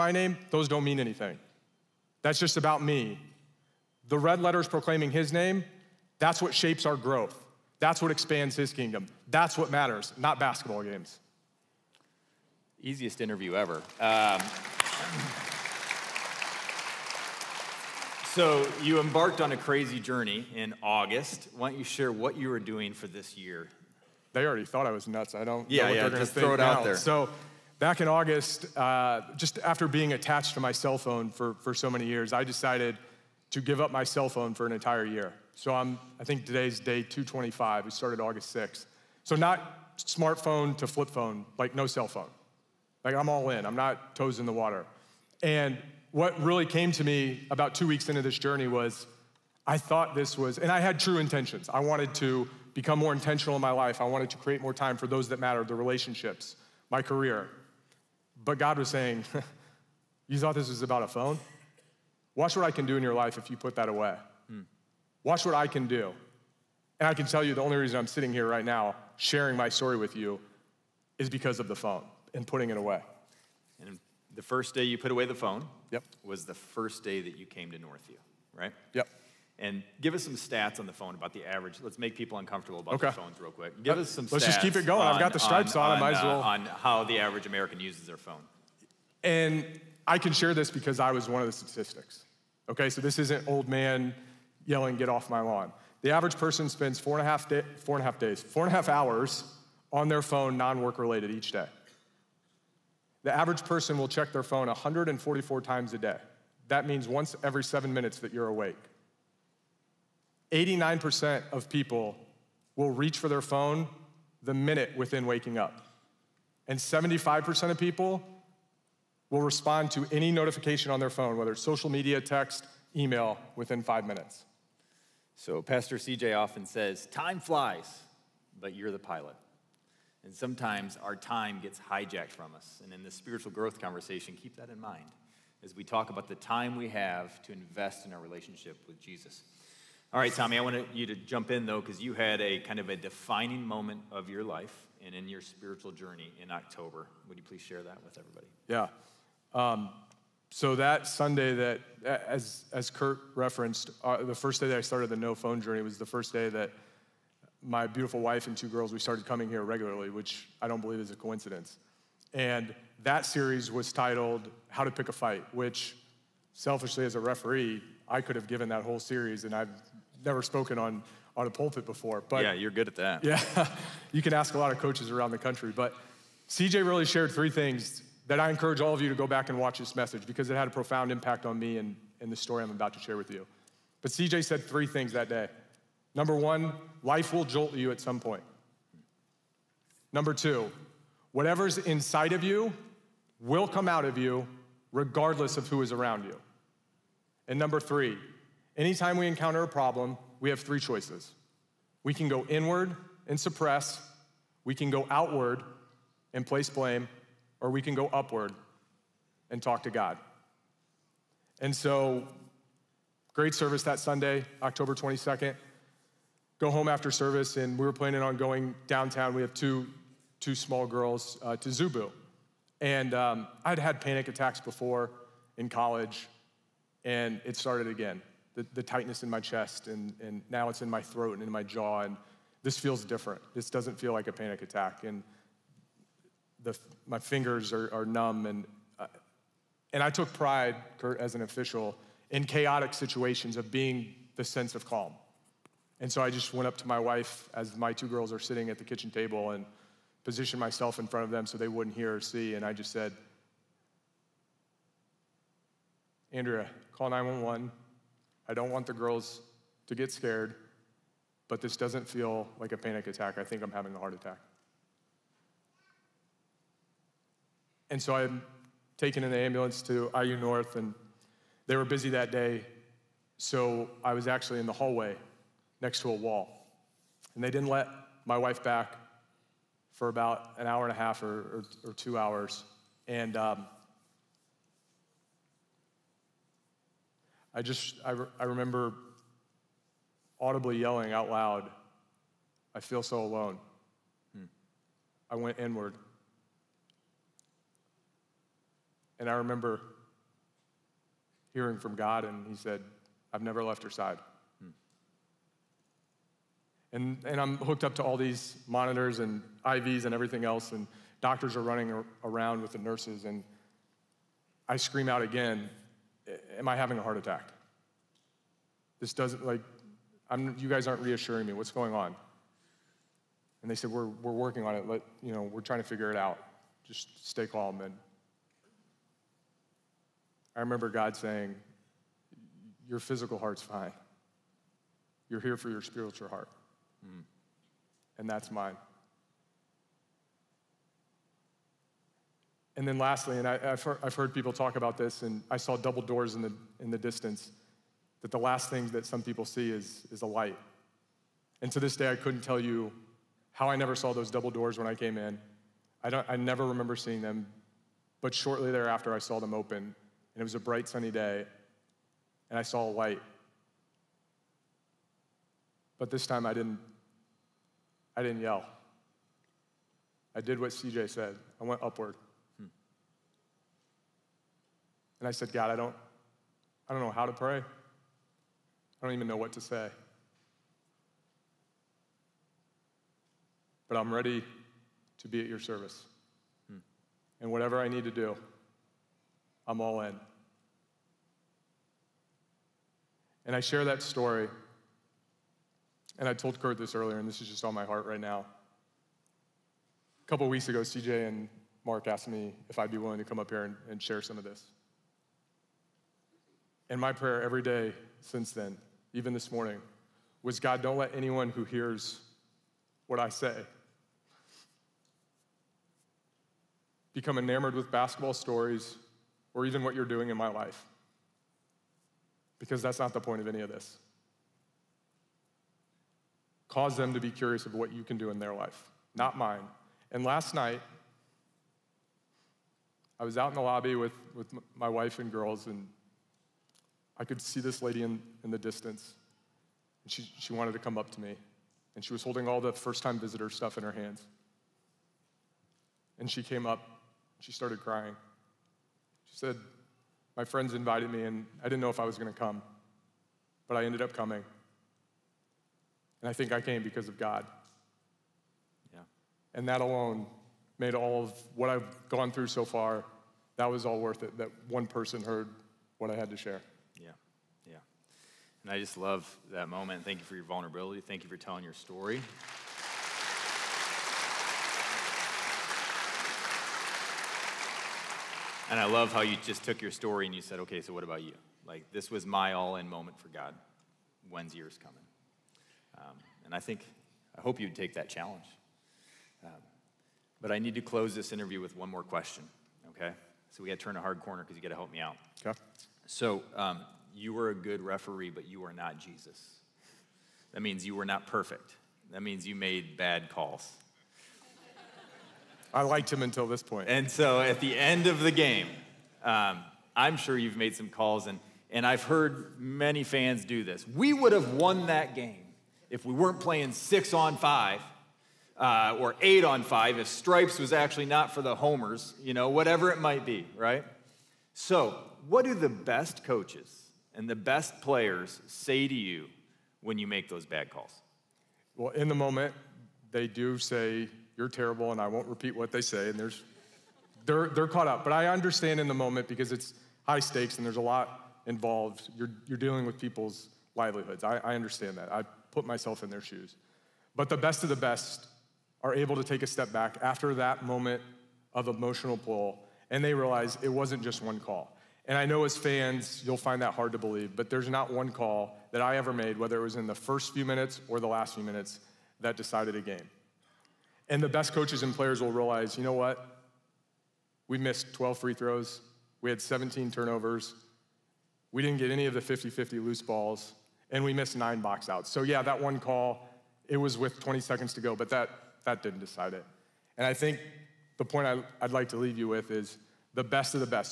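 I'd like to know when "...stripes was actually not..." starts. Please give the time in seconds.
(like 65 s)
520 s.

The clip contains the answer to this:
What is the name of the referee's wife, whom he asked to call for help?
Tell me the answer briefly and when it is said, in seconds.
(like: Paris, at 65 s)
Andrea, at 256 s.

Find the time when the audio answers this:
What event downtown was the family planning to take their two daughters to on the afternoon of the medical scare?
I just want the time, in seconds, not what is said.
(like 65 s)
221 s.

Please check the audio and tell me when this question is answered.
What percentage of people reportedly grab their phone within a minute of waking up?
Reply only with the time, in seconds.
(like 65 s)
110 s.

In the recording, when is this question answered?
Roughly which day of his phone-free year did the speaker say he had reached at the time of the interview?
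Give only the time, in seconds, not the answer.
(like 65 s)
37 s.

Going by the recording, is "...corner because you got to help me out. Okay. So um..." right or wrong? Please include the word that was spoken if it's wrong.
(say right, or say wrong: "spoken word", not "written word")
right.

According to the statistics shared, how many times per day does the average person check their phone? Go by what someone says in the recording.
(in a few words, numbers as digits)
144.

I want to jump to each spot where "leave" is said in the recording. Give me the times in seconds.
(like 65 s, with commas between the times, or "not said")
581 s.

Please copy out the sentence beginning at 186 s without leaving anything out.
Number one, life will jolt you at some point.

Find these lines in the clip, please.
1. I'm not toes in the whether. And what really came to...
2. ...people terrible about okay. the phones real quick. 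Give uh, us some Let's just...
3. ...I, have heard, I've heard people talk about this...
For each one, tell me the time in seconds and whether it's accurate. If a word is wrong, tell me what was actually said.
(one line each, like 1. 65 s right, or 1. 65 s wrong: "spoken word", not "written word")
1. 43 s wrong: "water", not "whether"
2. 82 s wrong: "uncomfortable", not "terrible"
3. 343 s right.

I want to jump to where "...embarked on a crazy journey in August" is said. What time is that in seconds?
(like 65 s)
19 s.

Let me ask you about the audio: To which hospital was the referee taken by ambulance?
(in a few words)
IU North.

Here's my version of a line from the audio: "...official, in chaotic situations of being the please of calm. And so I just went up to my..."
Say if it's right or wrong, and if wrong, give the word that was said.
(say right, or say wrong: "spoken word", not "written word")
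wrong: "sense", not "please".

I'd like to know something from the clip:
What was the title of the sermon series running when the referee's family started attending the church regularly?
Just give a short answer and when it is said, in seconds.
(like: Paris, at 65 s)
How to Pick a Fight, at 164 s.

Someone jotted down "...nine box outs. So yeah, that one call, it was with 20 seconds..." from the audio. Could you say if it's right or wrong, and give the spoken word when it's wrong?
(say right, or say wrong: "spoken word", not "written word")
right.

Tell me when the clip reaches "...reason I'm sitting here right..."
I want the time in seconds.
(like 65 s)
67 s.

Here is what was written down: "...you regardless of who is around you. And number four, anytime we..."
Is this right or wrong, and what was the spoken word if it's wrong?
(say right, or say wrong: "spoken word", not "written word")
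wrong: "three", not "four".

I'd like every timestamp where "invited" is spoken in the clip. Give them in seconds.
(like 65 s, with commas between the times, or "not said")
450 s.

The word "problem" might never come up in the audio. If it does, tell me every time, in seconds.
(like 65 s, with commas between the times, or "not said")
199 s.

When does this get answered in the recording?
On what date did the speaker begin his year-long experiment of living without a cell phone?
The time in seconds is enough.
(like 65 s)
38 s.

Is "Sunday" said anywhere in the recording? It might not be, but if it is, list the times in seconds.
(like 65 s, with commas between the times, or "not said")
151 s, 213 s.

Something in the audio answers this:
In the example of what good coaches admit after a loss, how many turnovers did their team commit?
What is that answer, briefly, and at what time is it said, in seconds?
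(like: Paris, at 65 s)
17, at 569 s.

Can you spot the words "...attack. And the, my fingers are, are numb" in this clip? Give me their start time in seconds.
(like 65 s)
234 s.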